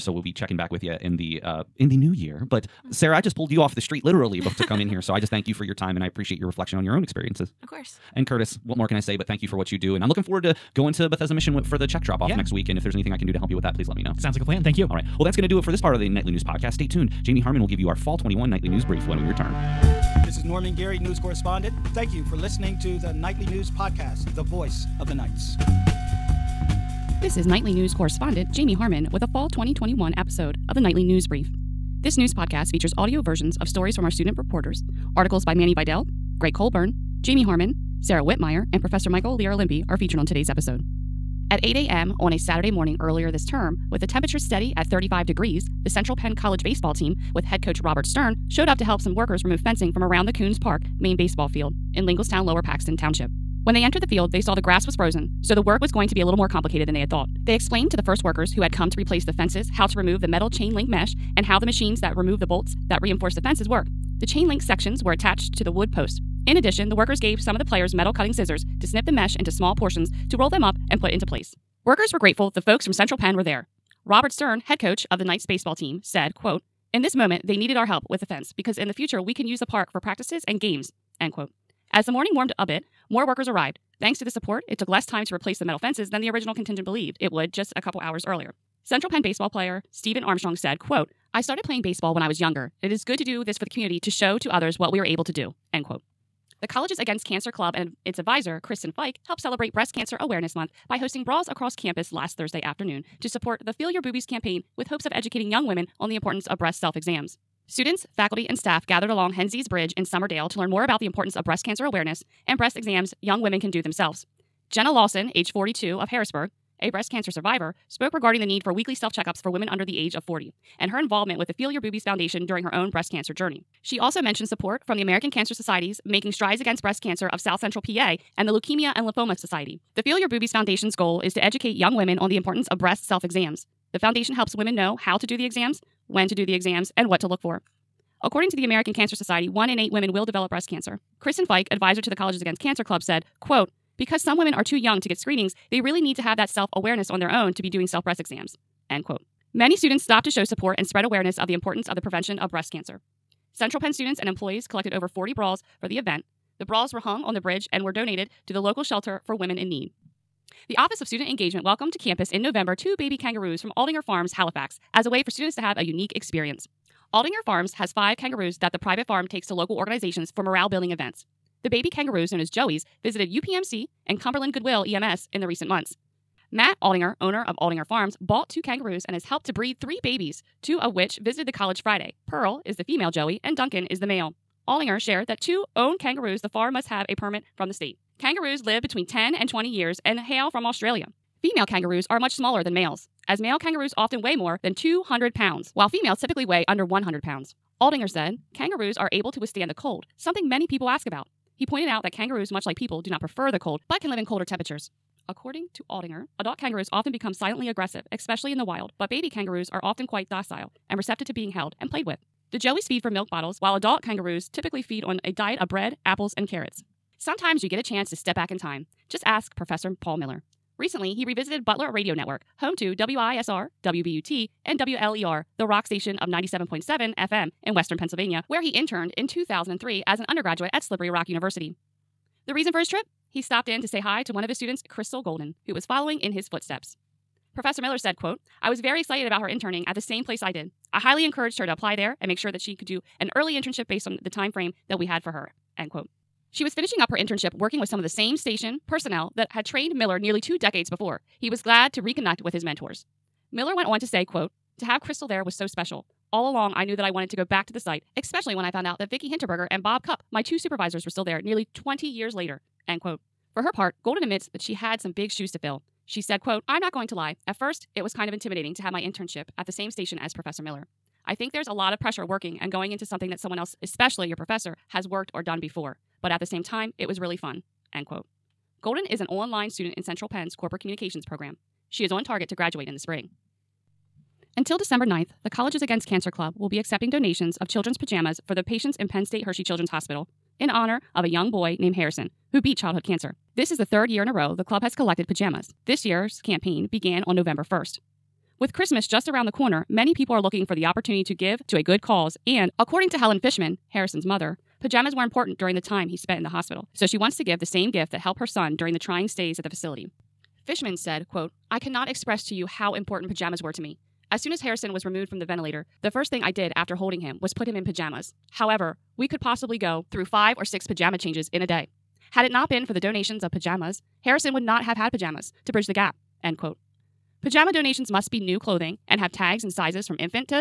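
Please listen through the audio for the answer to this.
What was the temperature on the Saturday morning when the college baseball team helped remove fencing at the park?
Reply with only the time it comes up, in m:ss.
0:44.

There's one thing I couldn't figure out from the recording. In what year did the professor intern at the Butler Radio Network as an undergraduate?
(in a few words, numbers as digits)
2003.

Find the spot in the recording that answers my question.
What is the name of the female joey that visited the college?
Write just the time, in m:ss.
3:02.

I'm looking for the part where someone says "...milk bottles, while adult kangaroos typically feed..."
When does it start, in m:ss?
3:33.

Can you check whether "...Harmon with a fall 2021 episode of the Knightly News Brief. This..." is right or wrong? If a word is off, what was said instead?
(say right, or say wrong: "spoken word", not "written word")
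right.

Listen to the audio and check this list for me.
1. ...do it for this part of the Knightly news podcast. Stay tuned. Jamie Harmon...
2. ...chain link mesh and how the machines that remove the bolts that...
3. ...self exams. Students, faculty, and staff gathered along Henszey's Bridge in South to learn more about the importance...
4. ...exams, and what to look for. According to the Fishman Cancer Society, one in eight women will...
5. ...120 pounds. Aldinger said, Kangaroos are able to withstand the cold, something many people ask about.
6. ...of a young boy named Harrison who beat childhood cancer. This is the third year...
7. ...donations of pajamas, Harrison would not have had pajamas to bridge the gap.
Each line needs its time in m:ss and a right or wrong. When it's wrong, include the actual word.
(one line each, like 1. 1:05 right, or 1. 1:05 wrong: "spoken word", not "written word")
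1. 0:15 right
2. 1:00 right
3. 1:46 wrong: "Summerdale", not "South"
4. 2:16 wrong: "American", not "Fishman"
5. 3:16 wrong: "100", not "120"
6. 4:51 right
7. 5:22 right.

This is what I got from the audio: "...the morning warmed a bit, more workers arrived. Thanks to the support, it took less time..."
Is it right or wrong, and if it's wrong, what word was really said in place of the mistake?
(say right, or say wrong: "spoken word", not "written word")
right.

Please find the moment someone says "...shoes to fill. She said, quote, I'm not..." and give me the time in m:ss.
4:25.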